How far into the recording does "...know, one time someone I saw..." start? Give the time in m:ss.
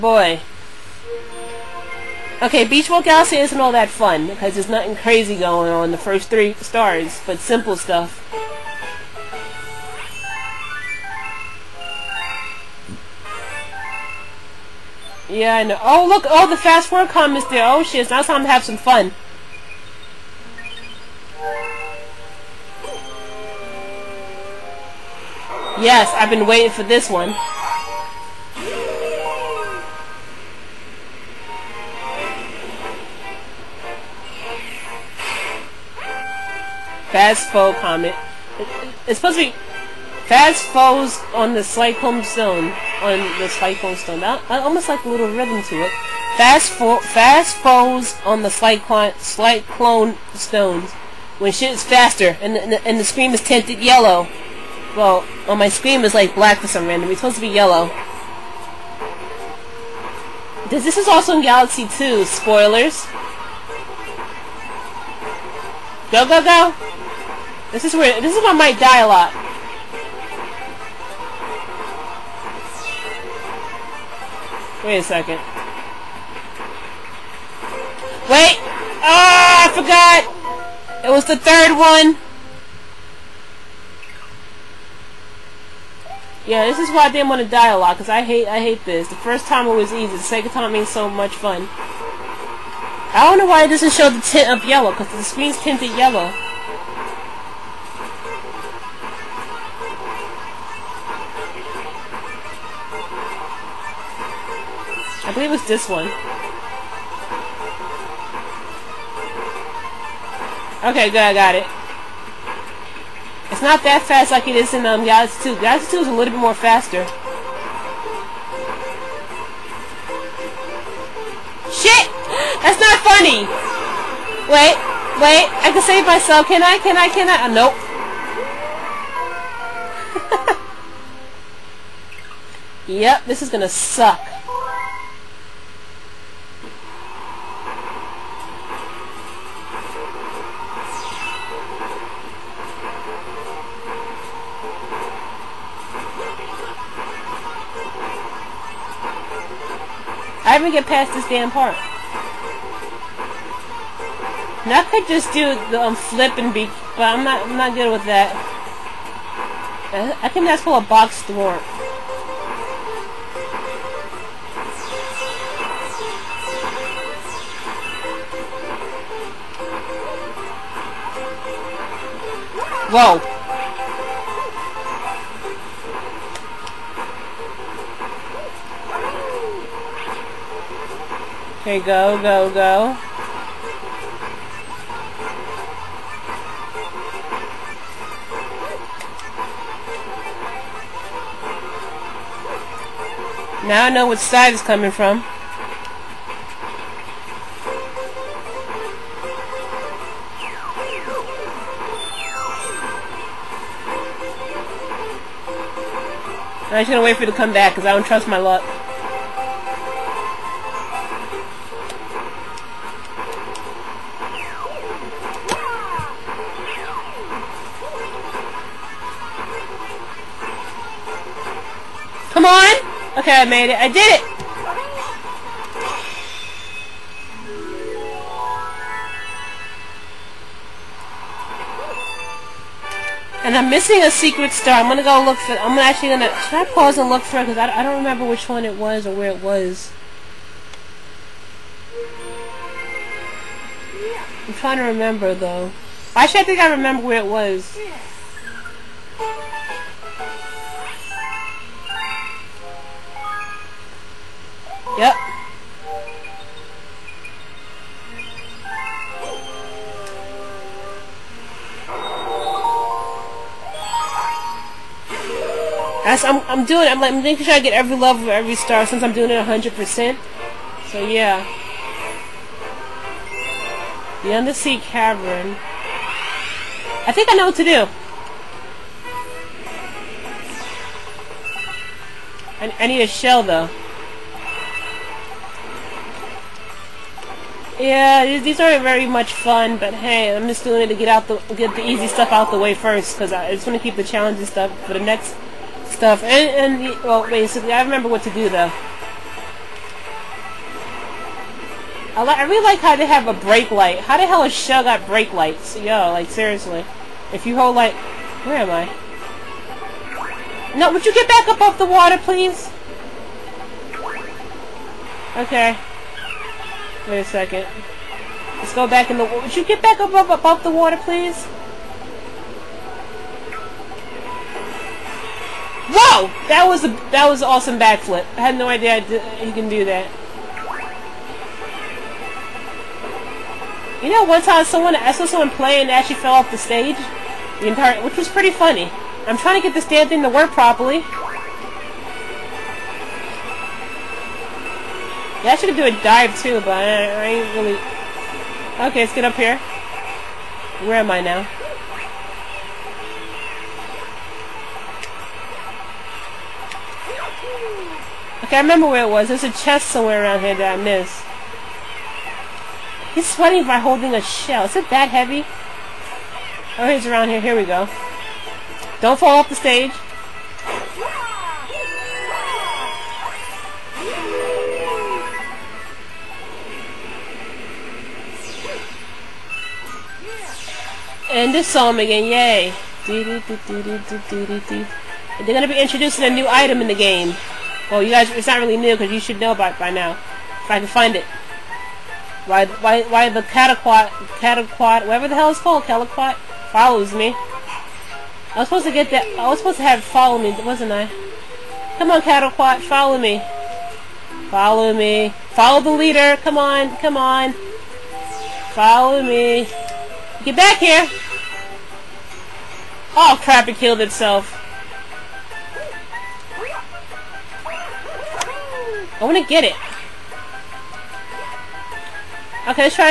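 5:34.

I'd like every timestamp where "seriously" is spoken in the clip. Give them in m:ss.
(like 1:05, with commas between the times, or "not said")
5:06.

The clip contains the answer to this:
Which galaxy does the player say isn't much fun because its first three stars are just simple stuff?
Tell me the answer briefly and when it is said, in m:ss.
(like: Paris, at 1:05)
Beach Galaxy, at 0:02.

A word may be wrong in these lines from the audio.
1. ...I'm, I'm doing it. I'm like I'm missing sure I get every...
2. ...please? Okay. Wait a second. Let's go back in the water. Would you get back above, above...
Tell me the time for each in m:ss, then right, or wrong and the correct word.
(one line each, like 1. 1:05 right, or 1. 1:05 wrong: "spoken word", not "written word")
1. 4:26 wrong: "making", not "missing"
2. 5:12 right.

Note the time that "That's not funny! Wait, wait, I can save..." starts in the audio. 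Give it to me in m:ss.
2:02.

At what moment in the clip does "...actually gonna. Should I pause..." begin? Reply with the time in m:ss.
3:55.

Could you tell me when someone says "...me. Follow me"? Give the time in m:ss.
6:43.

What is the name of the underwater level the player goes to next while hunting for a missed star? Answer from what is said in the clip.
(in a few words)
Undersea Cavern.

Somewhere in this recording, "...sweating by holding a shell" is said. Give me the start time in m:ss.
6:03.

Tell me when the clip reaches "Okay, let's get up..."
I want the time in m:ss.
5:48.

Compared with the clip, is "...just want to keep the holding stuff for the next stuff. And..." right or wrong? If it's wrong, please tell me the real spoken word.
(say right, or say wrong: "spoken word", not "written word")
wrong: "challenging", not "holding".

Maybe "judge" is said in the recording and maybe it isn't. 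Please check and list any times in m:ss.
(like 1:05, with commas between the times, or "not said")
not said.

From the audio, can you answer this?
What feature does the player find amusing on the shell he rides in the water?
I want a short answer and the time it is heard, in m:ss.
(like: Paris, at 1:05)
Brake lights, at 5:03.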